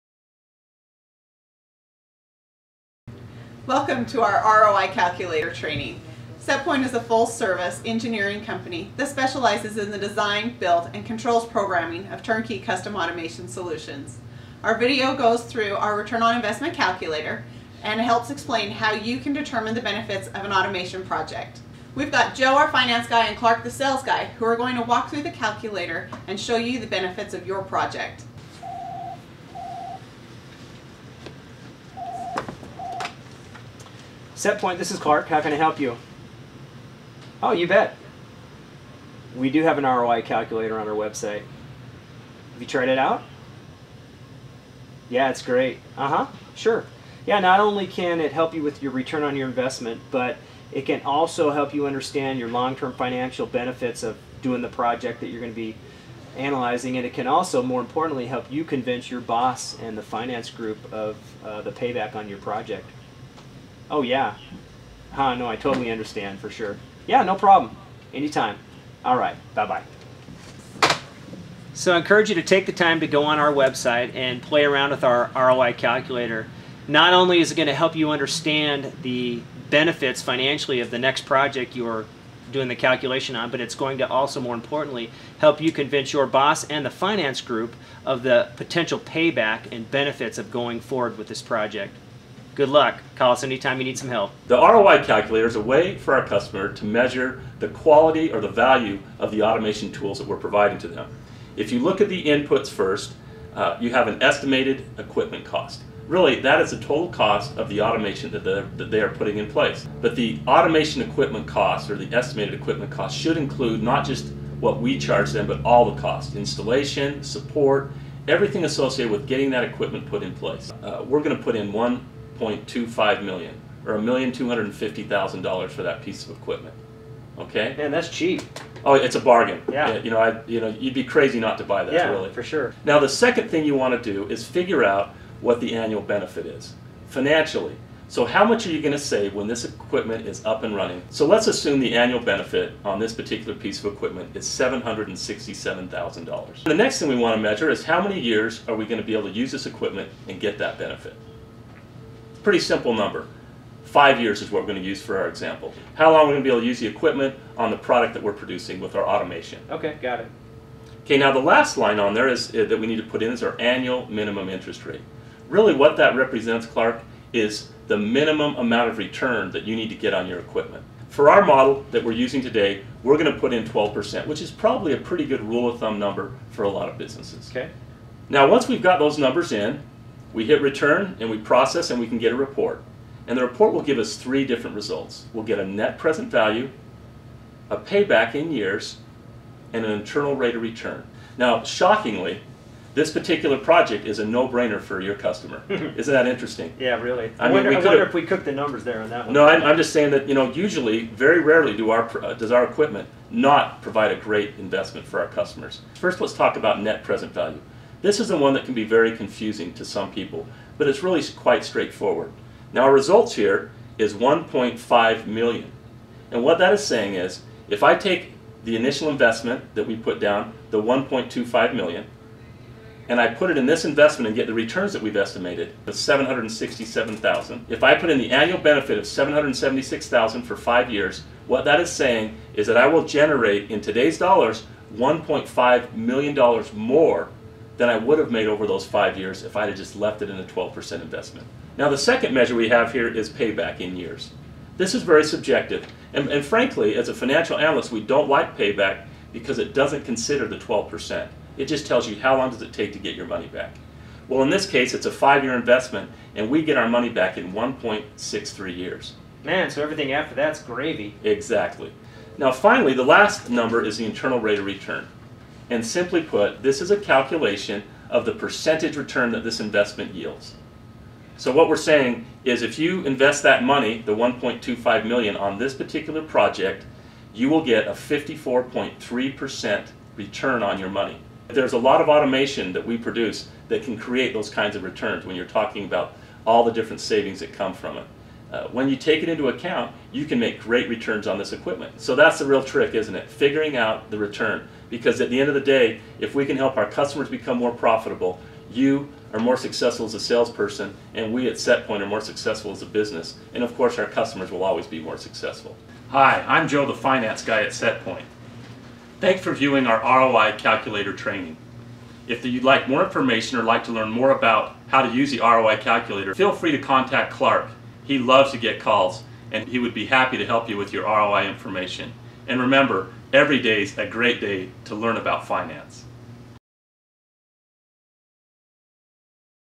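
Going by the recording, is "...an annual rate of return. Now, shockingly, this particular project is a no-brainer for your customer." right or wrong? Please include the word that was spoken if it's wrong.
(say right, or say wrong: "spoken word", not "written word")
wrong: "internal", not "annual".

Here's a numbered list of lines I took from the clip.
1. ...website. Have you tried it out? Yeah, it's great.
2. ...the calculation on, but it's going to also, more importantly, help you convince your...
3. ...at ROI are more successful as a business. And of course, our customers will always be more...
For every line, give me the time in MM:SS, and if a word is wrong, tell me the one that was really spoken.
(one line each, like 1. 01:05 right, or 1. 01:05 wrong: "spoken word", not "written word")
1. 00:40 right
2. 01:22 right
3. 05:01 wrong: "Setpoint", not "ROI".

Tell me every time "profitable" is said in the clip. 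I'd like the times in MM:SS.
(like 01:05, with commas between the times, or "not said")
04:57.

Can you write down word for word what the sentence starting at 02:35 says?
How long we're going to be able to use the equipment on the product that we're producing with our automation.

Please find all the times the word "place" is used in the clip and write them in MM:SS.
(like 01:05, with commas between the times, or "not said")
01:49, 02:00.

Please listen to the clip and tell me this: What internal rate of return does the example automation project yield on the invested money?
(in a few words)
54.3%.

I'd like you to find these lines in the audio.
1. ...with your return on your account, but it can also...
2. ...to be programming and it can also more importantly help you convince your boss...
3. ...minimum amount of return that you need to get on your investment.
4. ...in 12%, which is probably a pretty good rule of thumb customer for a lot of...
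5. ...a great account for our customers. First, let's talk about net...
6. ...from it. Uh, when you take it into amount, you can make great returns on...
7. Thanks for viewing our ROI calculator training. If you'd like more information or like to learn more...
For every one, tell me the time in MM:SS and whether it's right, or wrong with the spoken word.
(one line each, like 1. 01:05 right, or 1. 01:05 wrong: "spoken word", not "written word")
1. 00:48 wrong: "investment", not "account"
2. 00:55 wrong: "analyzing", not "programming"
3. 02:47 wrong: "equipment", not "investment"
4. 02:53 wrong: "number", not "customer"
5. 03:24 wrong: "investment", not "account"
6. 04:47 wrong: "account", not "amount"
7. 05:09 right.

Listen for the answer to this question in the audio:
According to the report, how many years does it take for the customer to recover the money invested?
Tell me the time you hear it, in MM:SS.
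04:17.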